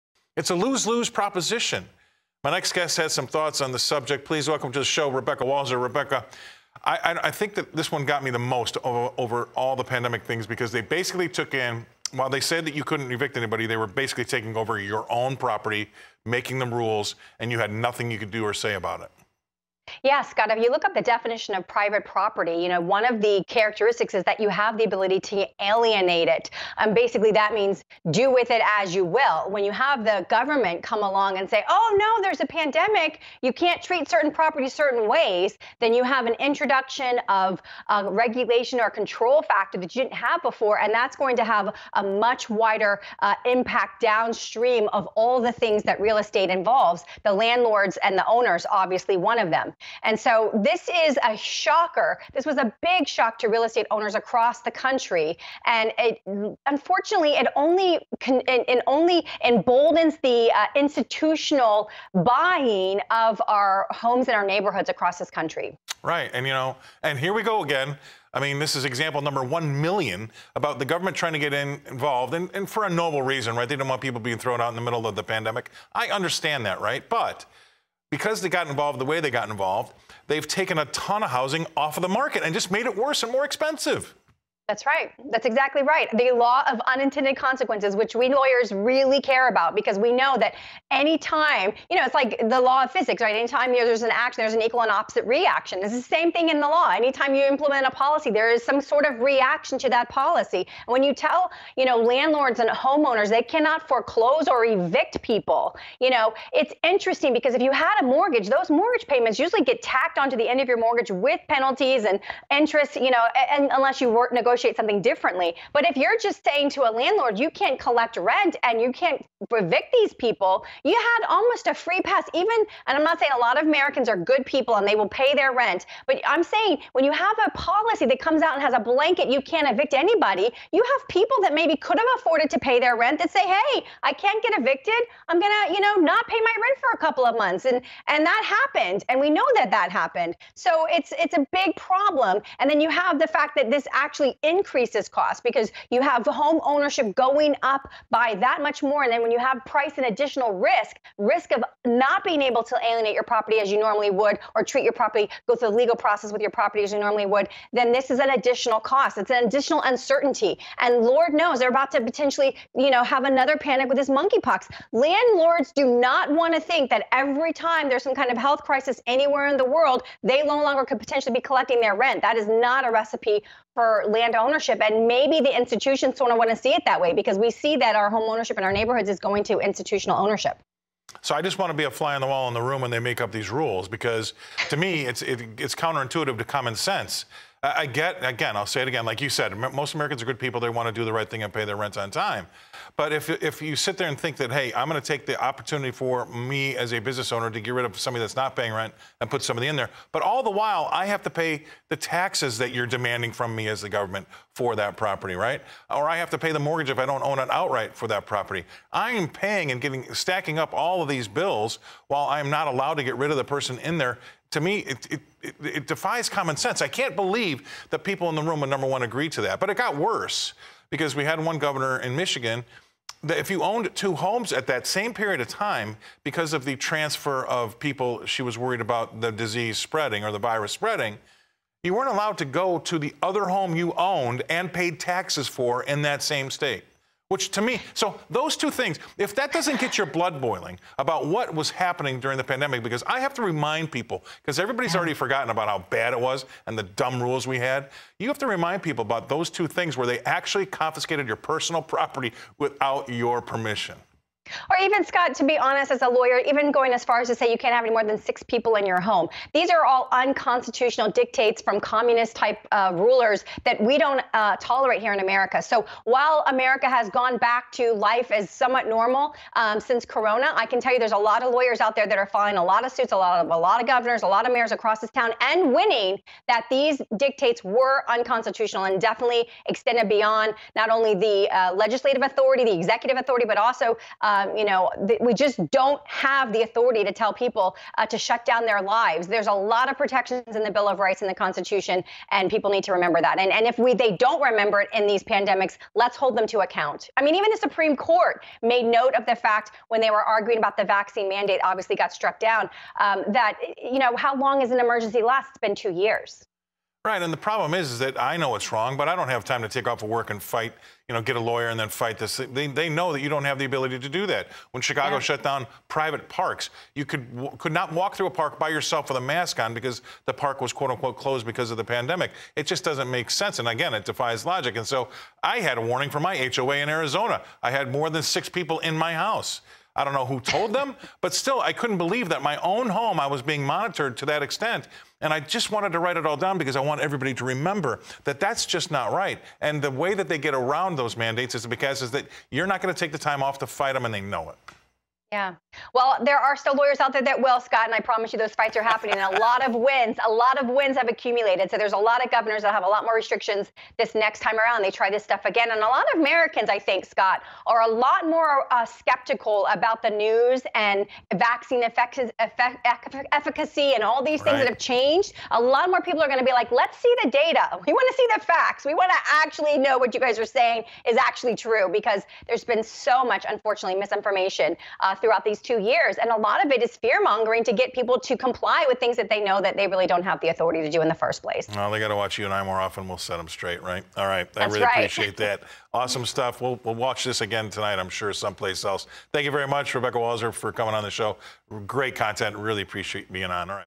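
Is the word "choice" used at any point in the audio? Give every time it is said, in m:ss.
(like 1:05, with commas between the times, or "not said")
not said.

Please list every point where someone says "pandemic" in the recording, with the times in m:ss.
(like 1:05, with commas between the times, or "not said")
0:09, 0:32, 1:15, 4:02, 4:55, 5:21.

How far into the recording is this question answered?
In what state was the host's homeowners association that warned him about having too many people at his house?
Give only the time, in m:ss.
5:26.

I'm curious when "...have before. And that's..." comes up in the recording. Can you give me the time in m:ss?
0:40.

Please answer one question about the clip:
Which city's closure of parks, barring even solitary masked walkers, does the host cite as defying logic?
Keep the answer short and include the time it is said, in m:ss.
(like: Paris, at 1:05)
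Chicago, at 5:14.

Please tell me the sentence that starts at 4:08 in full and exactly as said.
You have to remind people about those two things where they actually confiscated your personal property without your permission.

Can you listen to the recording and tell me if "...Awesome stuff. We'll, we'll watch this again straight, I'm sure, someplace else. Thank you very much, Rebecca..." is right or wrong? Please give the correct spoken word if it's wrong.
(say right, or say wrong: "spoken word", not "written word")
wrong: "tonight", not "straight".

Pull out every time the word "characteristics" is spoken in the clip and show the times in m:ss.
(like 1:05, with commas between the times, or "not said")
0:23.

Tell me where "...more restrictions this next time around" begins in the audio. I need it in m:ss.
5:53.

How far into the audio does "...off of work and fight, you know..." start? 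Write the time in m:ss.
5:09.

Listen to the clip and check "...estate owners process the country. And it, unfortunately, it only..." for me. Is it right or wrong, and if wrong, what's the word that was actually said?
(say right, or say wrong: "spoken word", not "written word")
wrong: "across", not "process".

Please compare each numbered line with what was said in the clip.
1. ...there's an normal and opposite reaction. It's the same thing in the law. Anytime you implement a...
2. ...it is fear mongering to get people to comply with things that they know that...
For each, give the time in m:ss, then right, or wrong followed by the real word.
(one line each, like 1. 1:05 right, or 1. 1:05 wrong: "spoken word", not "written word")
1. 1:34 wrong: "equal", not "normal"
2. 6:16 right.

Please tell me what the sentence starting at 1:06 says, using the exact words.
And, you know, and here we go again.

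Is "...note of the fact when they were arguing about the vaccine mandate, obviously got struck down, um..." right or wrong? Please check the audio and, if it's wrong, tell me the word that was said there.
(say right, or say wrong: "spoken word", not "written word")
right.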